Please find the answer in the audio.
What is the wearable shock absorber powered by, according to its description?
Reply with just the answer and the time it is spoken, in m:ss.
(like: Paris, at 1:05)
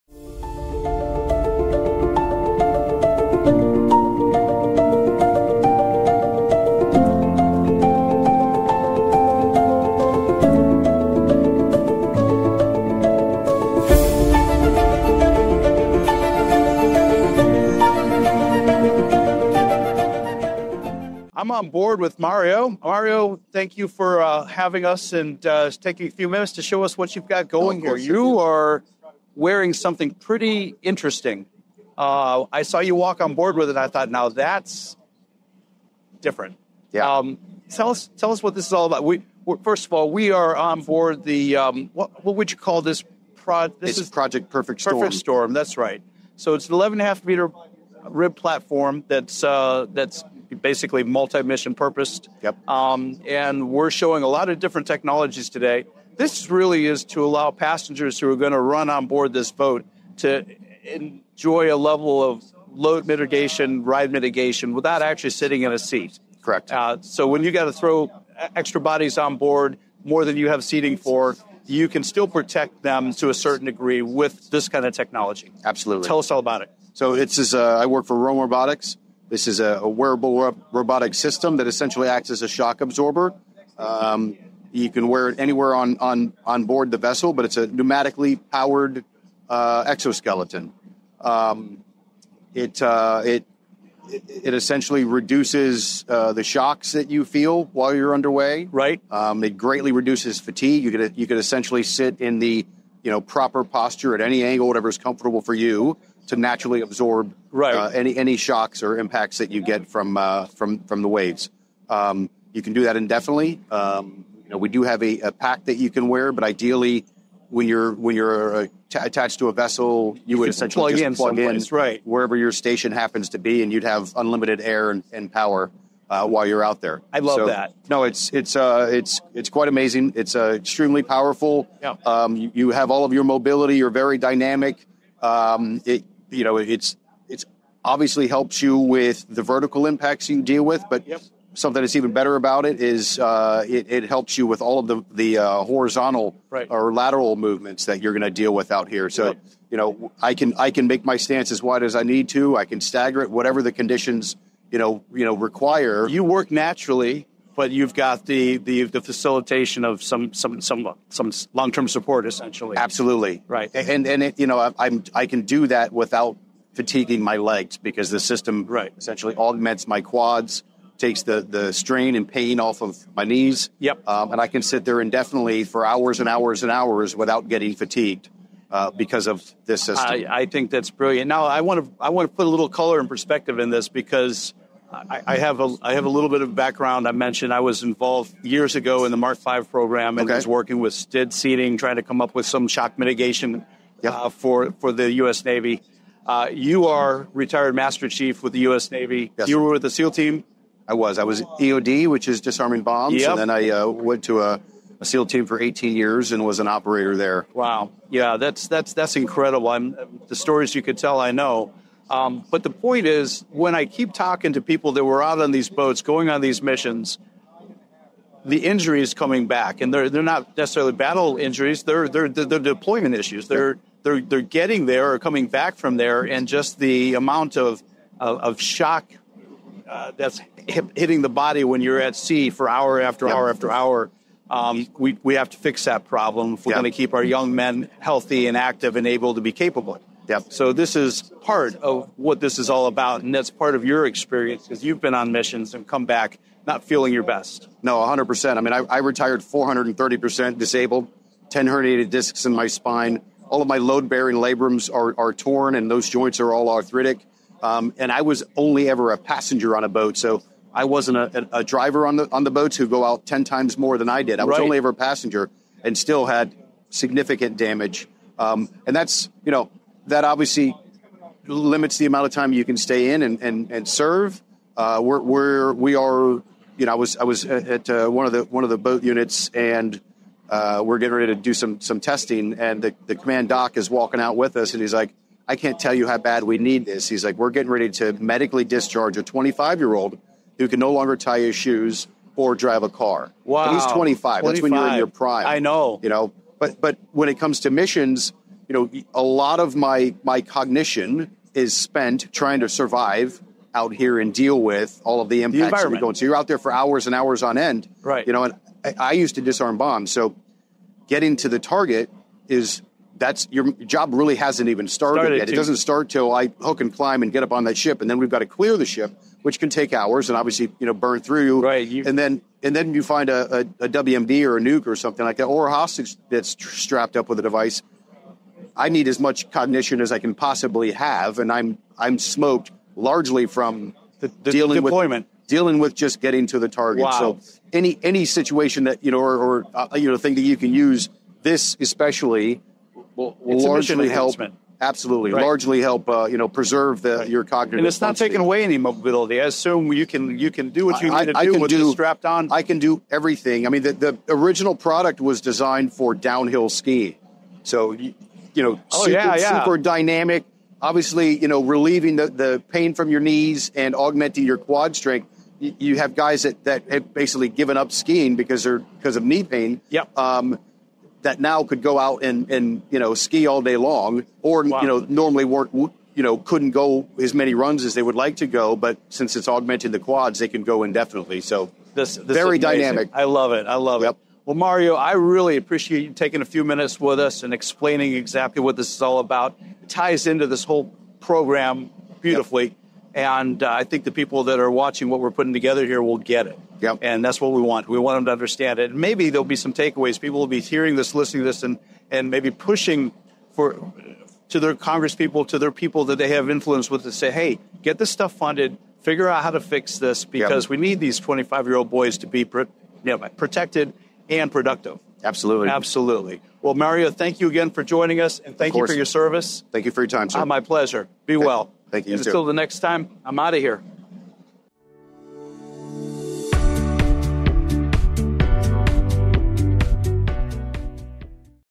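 Pneumatically, at 1:27.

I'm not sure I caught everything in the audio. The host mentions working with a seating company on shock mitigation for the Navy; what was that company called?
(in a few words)
STIDD.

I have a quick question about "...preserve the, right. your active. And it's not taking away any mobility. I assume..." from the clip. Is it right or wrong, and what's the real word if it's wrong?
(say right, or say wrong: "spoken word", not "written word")
wrong: "cognitive", not "active".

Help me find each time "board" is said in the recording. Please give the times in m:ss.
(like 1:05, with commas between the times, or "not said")
0:21, 0:33, 0:40, 0:59, 1:09, 1:26.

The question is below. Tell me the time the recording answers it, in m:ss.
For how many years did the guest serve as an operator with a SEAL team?
3:25.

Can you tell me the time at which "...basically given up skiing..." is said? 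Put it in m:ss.
6:07.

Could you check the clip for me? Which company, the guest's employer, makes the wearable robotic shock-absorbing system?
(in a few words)
Roam Robotics.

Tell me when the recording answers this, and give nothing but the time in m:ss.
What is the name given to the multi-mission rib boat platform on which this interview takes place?
0:44.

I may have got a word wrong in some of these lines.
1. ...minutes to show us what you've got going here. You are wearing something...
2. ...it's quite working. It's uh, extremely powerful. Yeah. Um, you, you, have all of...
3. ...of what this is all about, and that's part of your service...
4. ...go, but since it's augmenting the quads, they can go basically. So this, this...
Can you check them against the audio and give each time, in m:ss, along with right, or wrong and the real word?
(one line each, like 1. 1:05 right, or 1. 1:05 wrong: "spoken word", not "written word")
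1. 0:26 right
2. 2:09 wrong: "amazing", not "working"
3. 4:01 wrong: "experience", not "service"
4. 6:18 wrong: "indefinitely", not "basically".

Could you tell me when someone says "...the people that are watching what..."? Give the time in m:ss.
6:34.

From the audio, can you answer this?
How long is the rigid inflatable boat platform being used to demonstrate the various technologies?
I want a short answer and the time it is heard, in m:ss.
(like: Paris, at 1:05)
11.5 meters, at 0:46.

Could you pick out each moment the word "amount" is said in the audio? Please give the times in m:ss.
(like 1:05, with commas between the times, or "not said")
3:47, 4:32.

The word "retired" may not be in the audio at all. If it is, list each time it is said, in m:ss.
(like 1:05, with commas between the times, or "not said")
3:17, 4:08.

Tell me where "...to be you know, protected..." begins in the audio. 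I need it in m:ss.
6:52.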